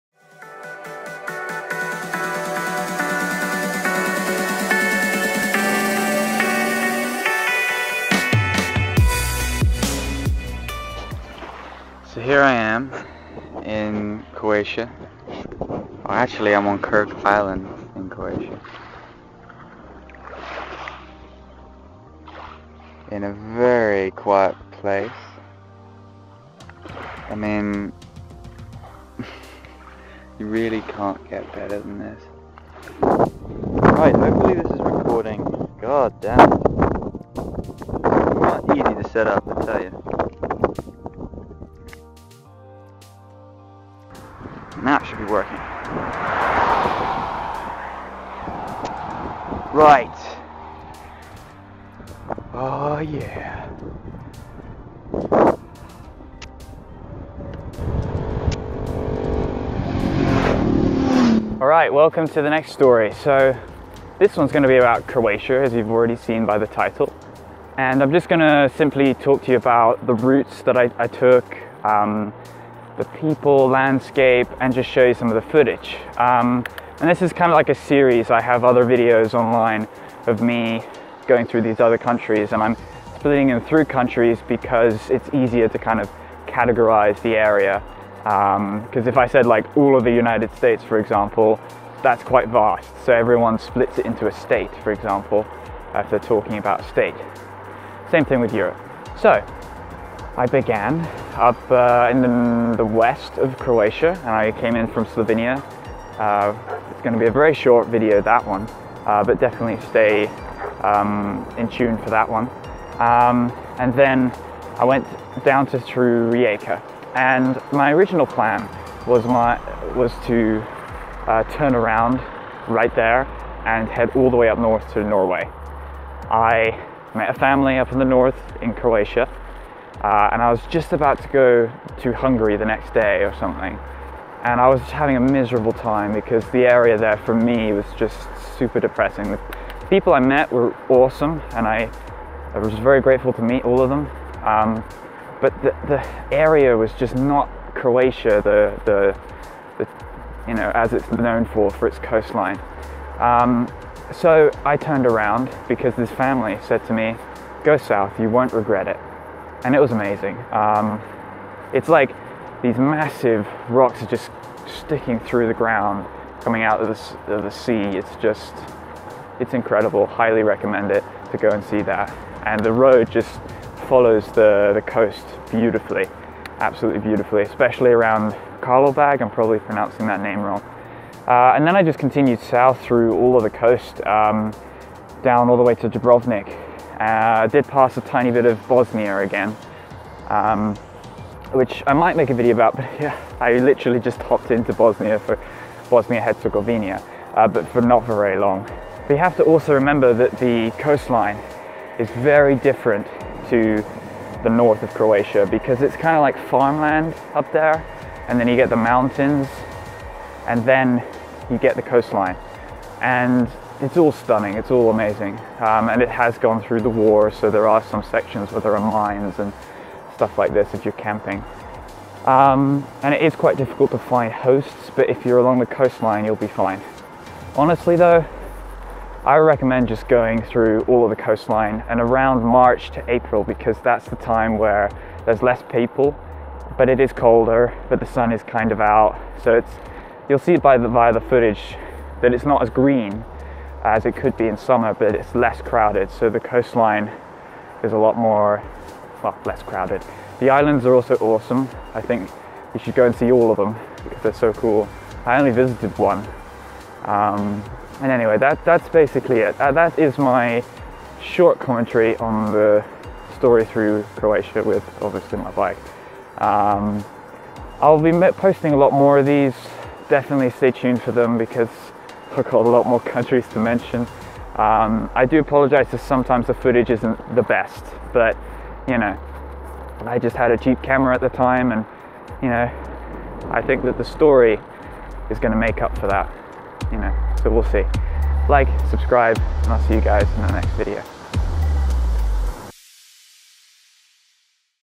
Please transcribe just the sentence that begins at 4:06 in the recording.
So the coastline is a lot more, well, less crowded.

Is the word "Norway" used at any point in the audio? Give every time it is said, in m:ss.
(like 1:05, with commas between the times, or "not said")
2:05.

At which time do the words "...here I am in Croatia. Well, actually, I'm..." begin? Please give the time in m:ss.
0:12.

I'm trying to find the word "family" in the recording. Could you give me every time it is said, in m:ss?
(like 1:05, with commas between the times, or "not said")
2:07, 2:36.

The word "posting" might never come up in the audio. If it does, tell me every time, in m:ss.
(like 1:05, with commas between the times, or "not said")
4:28.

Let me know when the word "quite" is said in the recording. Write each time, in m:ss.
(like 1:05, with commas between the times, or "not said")
1:32, 3:43.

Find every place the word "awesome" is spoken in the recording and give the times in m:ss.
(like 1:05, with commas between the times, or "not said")
2:20, 4:11.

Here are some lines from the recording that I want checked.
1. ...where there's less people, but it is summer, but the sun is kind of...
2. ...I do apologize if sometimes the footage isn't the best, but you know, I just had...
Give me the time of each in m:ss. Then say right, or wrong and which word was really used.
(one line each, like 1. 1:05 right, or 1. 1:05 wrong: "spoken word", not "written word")
1. 3:54 wrong: "colder", not "summer"
2. 4:35 right.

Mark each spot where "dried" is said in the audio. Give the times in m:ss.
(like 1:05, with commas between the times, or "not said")
not said.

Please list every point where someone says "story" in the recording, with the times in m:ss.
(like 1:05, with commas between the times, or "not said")
1:02, 4:23, 4:44.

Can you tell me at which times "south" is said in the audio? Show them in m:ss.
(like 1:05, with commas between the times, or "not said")
2:37, 3:02.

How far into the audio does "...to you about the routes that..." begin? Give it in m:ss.
1:09.